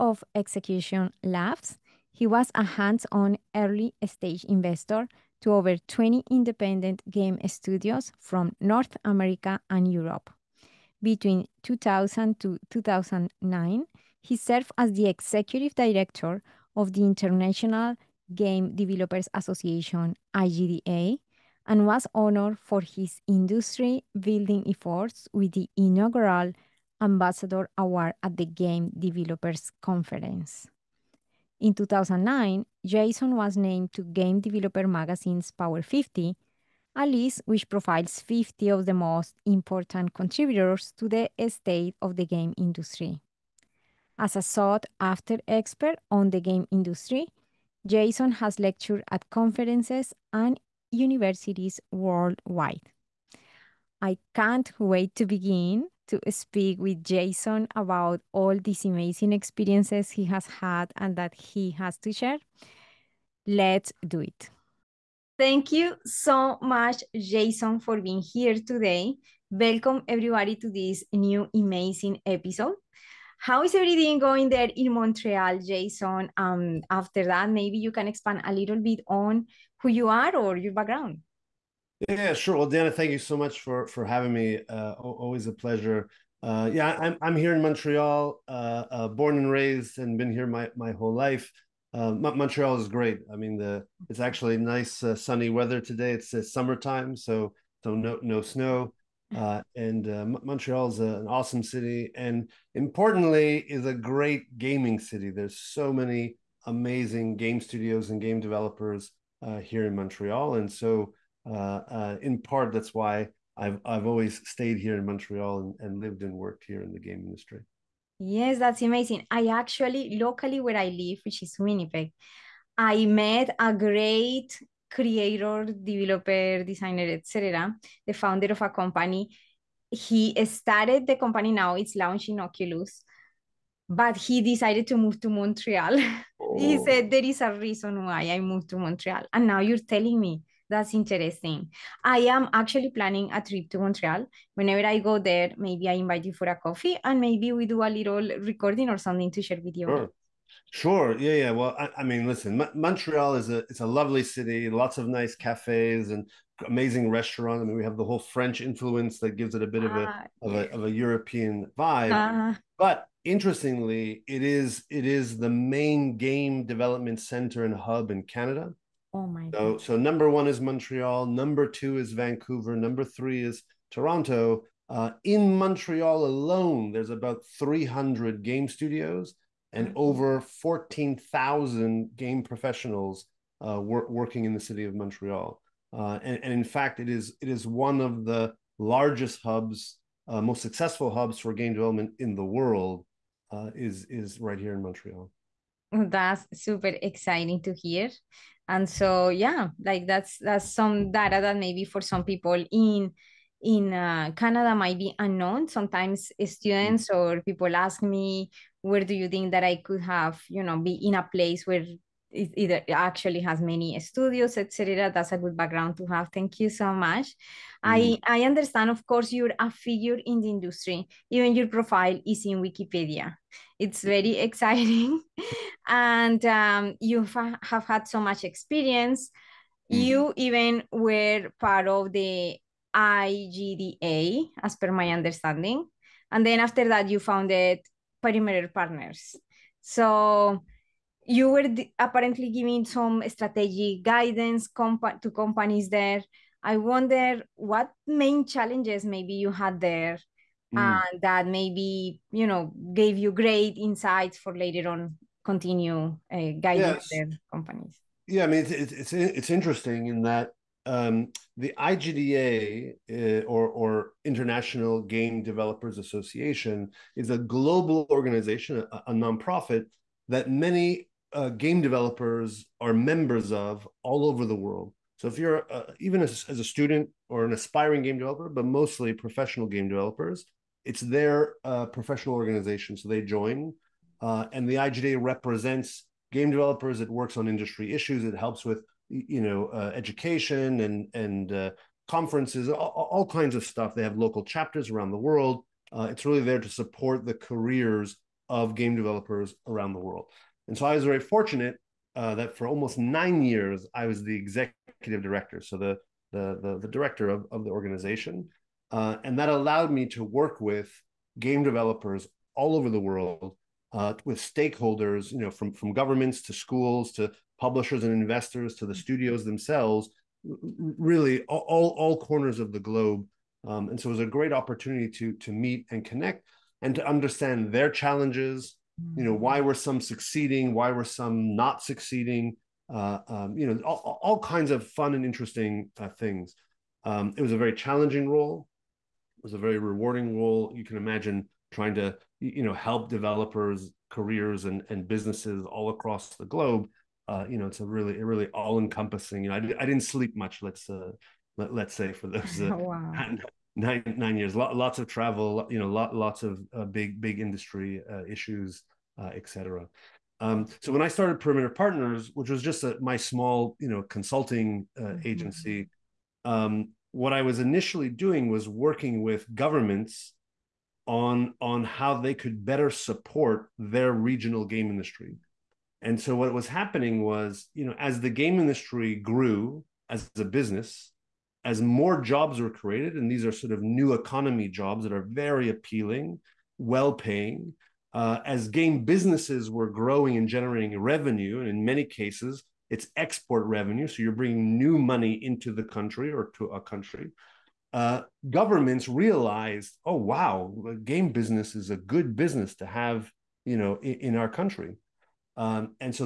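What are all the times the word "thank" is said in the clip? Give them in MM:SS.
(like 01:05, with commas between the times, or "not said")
01:05, 01:22, 03:36.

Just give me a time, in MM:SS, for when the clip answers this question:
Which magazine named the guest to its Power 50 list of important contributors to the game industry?
00:34.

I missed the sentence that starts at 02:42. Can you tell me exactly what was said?
Uh, but interestingly, it is it is the main game development center and hub in Canada.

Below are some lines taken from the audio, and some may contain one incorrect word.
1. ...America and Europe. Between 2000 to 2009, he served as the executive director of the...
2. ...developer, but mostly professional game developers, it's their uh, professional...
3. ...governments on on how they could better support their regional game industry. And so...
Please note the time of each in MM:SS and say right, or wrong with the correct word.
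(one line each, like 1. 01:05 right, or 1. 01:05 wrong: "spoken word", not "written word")
1. 00:09 right
2. 04:38 right
3. 06:09 right.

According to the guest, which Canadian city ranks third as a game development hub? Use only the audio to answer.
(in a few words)
Toronto.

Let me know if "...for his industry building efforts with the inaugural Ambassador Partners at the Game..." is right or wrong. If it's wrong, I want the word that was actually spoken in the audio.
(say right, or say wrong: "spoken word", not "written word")
wrong: "Award", not "Partners".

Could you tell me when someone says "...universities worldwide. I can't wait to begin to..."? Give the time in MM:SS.
00:50.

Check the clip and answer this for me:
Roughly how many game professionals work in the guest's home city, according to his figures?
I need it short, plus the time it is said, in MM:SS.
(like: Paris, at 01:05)
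over 14,000, at 02:59.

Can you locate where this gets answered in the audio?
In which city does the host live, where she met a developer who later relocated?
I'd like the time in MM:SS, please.
02:01.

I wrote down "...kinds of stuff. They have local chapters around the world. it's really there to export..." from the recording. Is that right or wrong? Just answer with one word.
wrong.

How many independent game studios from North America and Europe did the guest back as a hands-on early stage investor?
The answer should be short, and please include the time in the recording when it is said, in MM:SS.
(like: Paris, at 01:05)
over 20, at 00:05.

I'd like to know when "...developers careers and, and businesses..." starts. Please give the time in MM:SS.
05:43.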